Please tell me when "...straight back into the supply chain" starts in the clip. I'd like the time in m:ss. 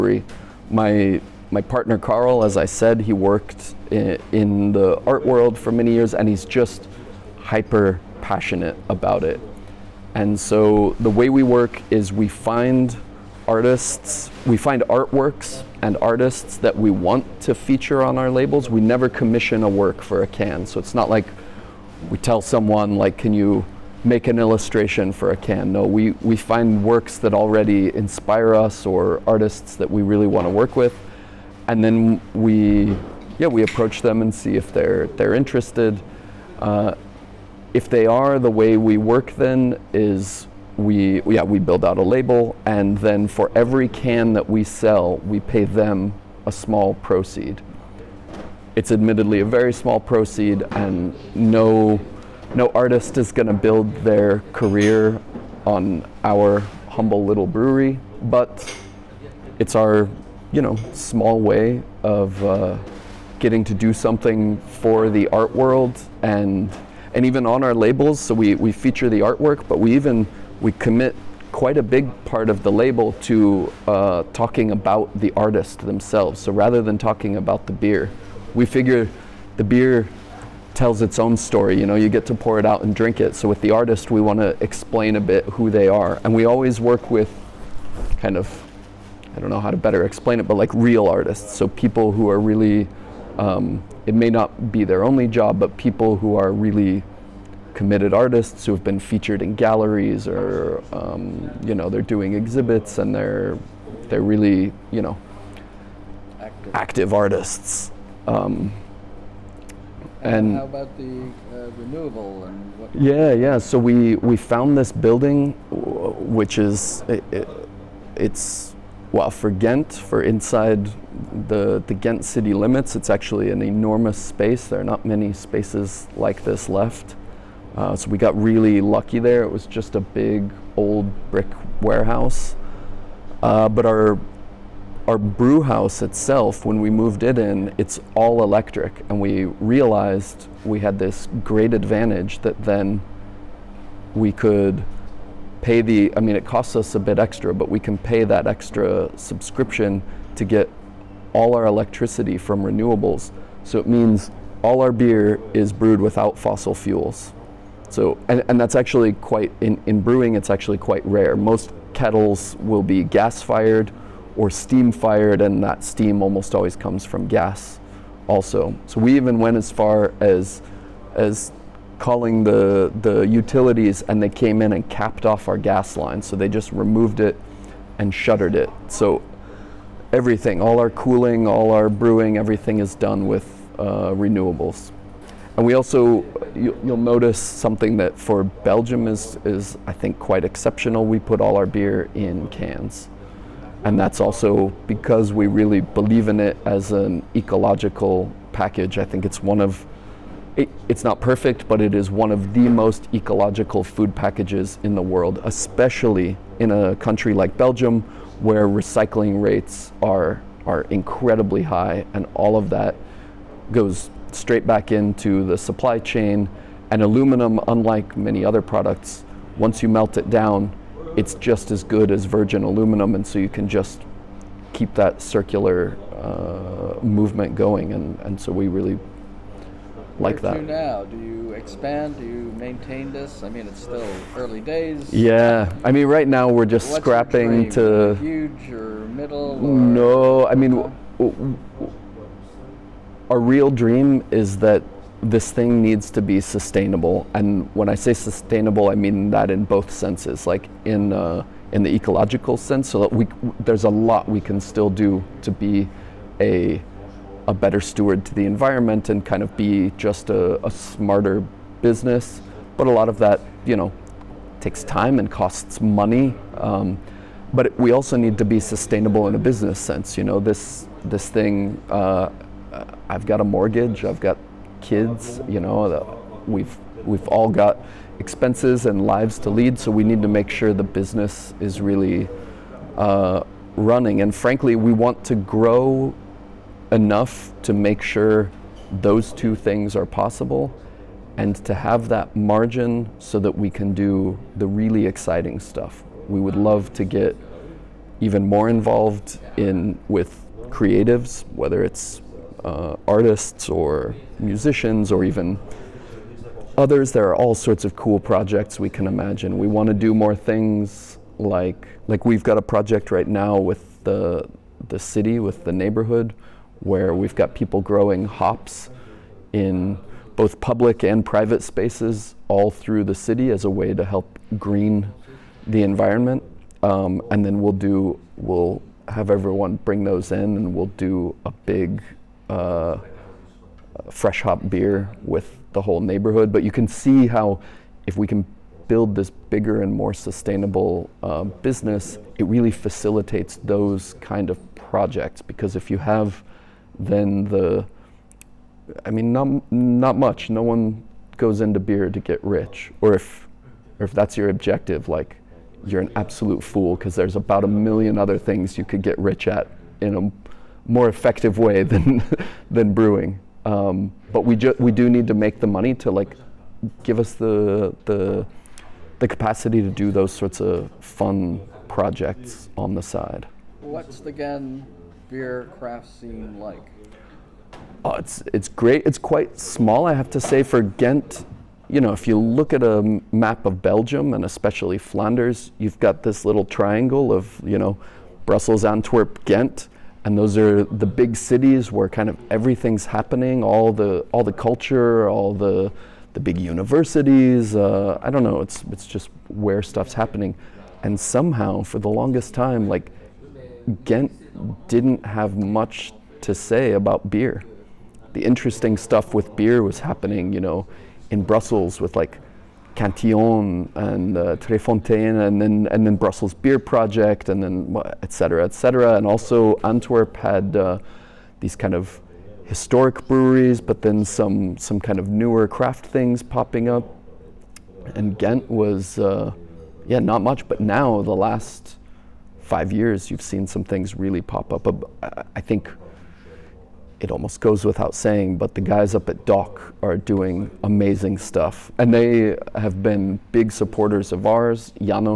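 3:34.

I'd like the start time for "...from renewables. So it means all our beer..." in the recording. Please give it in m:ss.
2:32.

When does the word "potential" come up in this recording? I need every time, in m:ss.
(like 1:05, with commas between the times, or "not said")
not said.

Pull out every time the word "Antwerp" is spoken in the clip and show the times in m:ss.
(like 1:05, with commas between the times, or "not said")
6:28, 6:59.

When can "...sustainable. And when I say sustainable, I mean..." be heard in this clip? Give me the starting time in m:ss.
4:06.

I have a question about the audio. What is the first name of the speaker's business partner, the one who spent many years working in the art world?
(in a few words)
Carl.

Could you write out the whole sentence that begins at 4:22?
But a lot of that, you know, takes time and costs money.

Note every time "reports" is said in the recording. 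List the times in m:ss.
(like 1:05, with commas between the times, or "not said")
not said.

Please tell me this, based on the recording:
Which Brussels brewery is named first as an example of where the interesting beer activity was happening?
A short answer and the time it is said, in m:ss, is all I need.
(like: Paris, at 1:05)
Cantillon, at 6:52.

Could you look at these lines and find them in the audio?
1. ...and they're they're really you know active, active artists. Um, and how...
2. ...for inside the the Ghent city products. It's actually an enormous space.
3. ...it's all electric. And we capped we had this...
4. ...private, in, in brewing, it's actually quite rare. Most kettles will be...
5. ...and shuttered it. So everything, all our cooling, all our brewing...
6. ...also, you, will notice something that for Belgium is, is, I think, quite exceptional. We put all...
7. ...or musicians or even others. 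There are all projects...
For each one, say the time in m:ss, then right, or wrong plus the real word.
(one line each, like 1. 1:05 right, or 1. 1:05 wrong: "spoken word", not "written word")
1. 1:42 right
2. 1:59 wrong: "limits", not "products"
3. 2:17 wrong: "realized", not "capped"
4. 2:39 wrong: "quite", not "private"
5. 2:57 right
6. 3:05 right
7. 5:03 wrong: "sorts", not "projects".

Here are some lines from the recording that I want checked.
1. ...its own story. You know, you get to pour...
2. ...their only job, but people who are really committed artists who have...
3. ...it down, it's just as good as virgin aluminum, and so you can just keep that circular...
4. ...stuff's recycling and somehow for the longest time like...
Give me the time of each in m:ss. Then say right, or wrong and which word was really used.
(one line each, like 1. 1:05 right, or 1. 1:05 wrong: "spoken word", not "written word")
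1. 1:21 right
2. 1:34 right
3. 3:40 right
4. 6:39 wrong: "happening", not "recycling".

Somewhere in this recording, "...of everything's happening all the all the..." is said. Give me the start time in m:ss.
6:32.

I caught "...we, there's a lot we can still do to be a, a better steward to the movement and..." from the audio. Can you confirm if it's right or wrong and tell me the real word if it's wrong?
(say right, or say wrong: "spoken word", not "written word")
wrong: "environment", not "movement".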